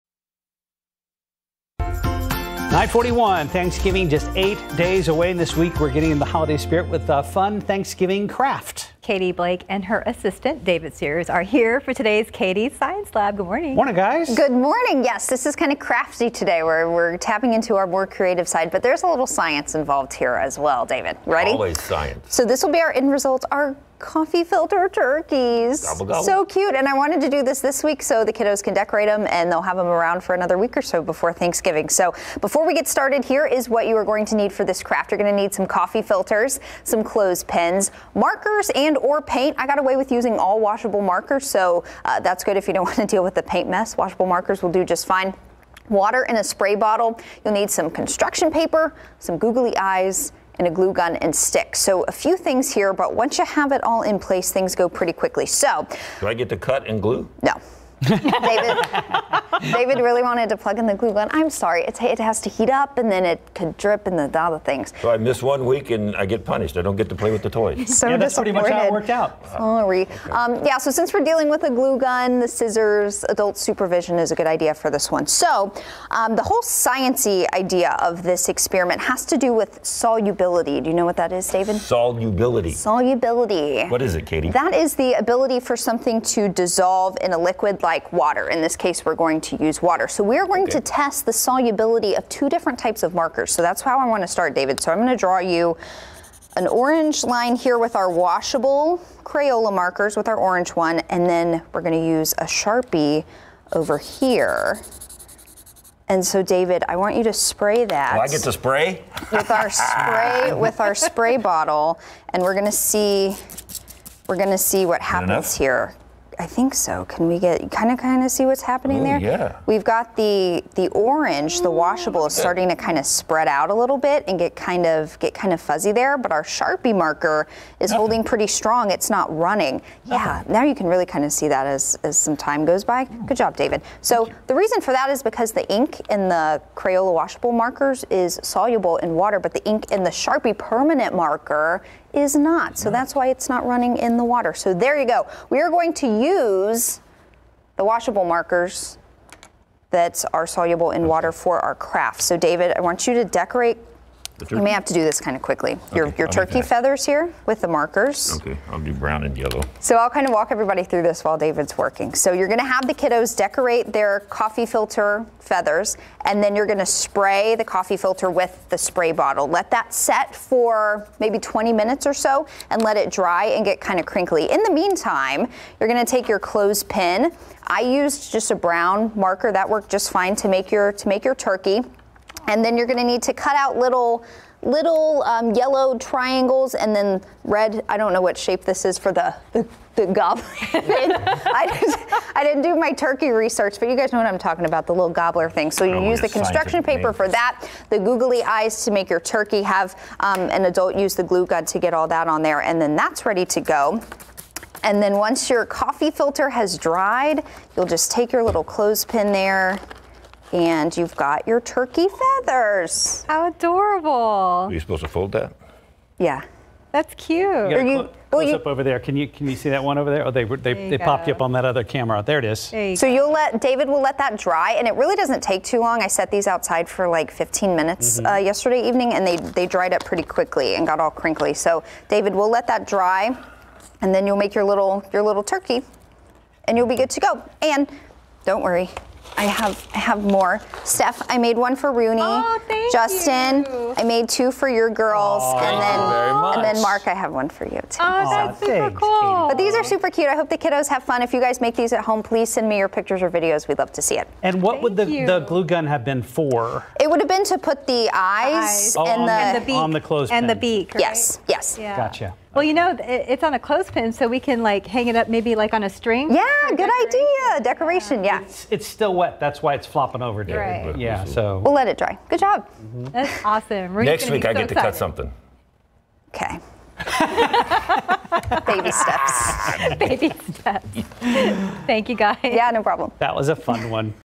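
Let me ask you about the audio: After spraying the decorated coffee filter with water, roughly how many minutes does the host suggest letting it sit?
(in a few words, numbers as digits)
20.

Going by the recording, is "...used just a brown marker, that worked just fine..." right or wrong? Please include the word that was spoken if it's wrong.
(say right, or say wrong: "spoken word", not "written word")
right.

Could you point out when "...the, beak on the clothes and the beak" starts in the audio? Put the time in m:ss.
4:19.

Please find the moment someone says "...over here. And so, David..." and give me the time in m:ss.
1:43.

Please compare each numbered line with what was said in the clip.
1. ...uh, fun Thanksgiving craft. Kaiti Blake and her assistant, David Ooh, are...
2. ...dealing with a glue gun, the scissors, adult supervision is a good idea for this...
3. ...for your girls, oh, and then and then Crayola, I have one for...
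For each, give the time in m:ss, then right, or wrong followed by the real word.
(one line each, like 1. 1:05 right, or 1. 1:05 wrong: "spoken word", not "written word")
1. 0:07 wrong: "Sears", not "Ooh"
2. 1:11 right
3. 4:04 wrong: "Mark", not "Crayola".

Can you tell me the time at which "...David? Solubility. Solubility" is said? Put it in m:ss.
1:21.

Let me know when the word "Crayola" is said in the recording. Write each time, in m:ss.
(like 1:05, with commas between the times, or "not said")
1:39, 2:16.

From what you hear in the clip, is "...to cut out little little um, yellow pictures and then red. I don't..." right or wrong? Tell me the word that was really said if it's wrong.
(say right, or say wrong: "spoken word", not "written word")
wrong: "triangles", not "pictures".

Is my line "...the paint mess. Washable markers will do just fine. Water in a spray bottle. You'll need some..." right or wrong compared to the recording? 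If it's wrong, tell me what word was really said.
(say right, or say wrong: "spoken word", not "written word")
right.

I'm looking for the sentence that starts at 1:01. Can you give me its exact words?
I'm sorry, it's, it has to heat up and then it could drip and the other things.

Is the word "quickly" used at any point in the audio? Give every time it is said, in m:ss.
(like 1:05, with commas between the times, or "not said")
0:55, 2:35, 3:50.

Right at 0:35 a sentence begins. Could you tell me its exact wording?
You're going to need some coffee filters, some clothespins, markers, and or paint.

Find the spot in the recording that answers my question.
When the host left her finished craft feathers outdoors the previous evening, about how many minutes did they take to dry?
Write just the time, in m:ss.
3:47.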